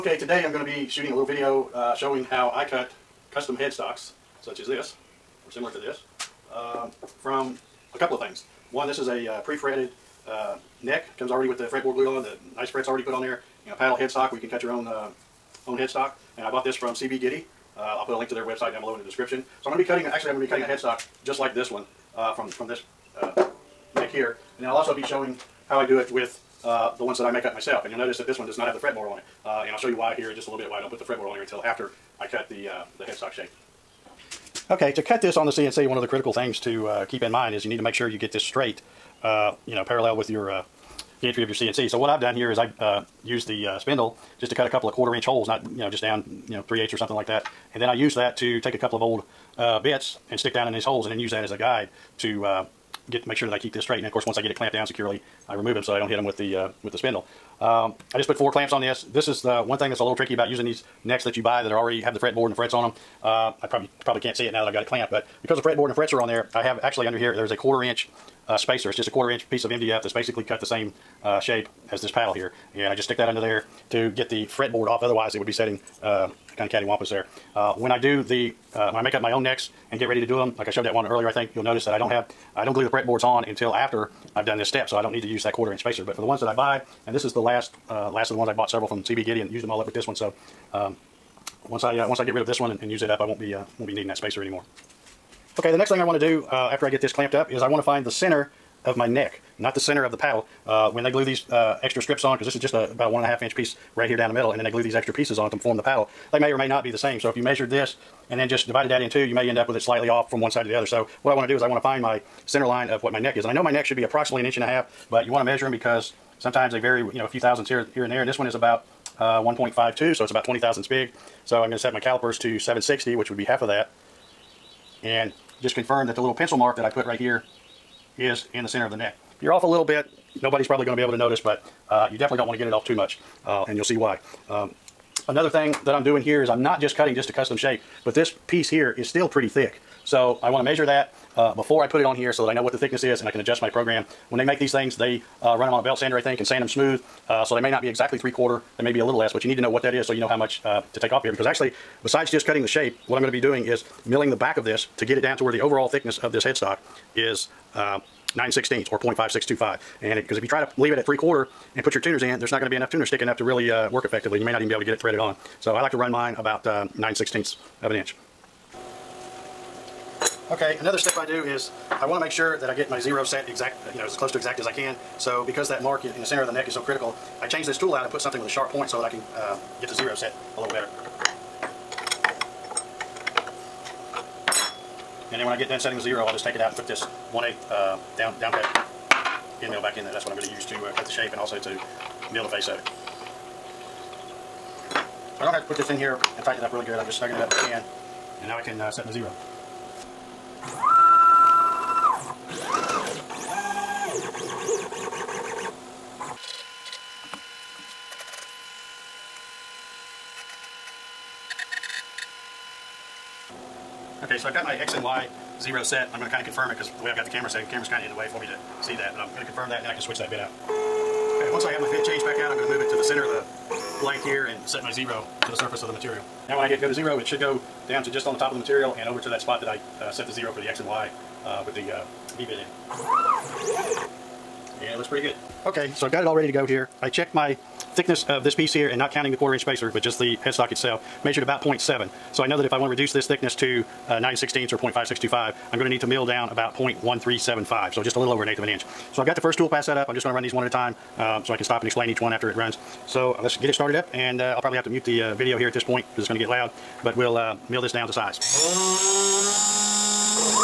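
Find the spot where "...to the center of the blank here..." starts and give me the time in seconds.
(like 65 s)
222 s.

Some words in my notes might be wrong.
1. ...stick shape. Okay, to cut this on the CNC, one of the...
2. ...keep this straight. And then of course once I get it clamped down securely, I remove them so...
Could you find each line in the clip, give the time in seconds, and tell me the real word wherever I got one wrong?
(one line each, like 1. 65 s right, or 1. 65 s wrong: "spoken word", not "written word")
1. 33 s wrong: "headstock", not "stick"
2. 53 s right.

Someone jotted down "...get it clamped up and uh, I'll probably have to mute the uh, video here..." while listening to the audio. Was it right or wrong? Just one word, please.
wrong.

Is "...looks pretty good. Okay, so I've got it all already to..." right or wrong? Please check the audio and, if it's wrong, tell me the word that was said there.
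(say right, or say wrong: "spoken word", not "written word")
wrong: "ready", not "already".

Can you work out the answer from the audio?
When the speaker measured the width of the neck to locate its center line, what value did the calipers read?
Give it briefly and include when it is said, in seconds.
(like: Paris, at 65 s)
1.52, at 119 s.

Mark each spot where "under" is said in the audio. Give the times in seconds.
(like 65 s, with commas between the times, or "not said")
67 s, 73 s.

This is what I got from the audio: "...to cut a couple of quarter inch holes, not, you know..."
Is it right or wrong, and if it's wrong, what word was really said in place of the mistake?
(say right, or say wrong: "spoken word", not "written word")
right.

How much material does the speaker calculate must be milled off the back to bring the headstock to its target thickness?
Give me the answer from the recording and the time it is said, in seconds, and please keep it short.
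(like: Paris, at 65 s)
0.1375, at 246 s.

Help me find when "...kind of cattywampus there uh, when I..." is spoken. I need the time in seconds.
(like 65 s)
76 s.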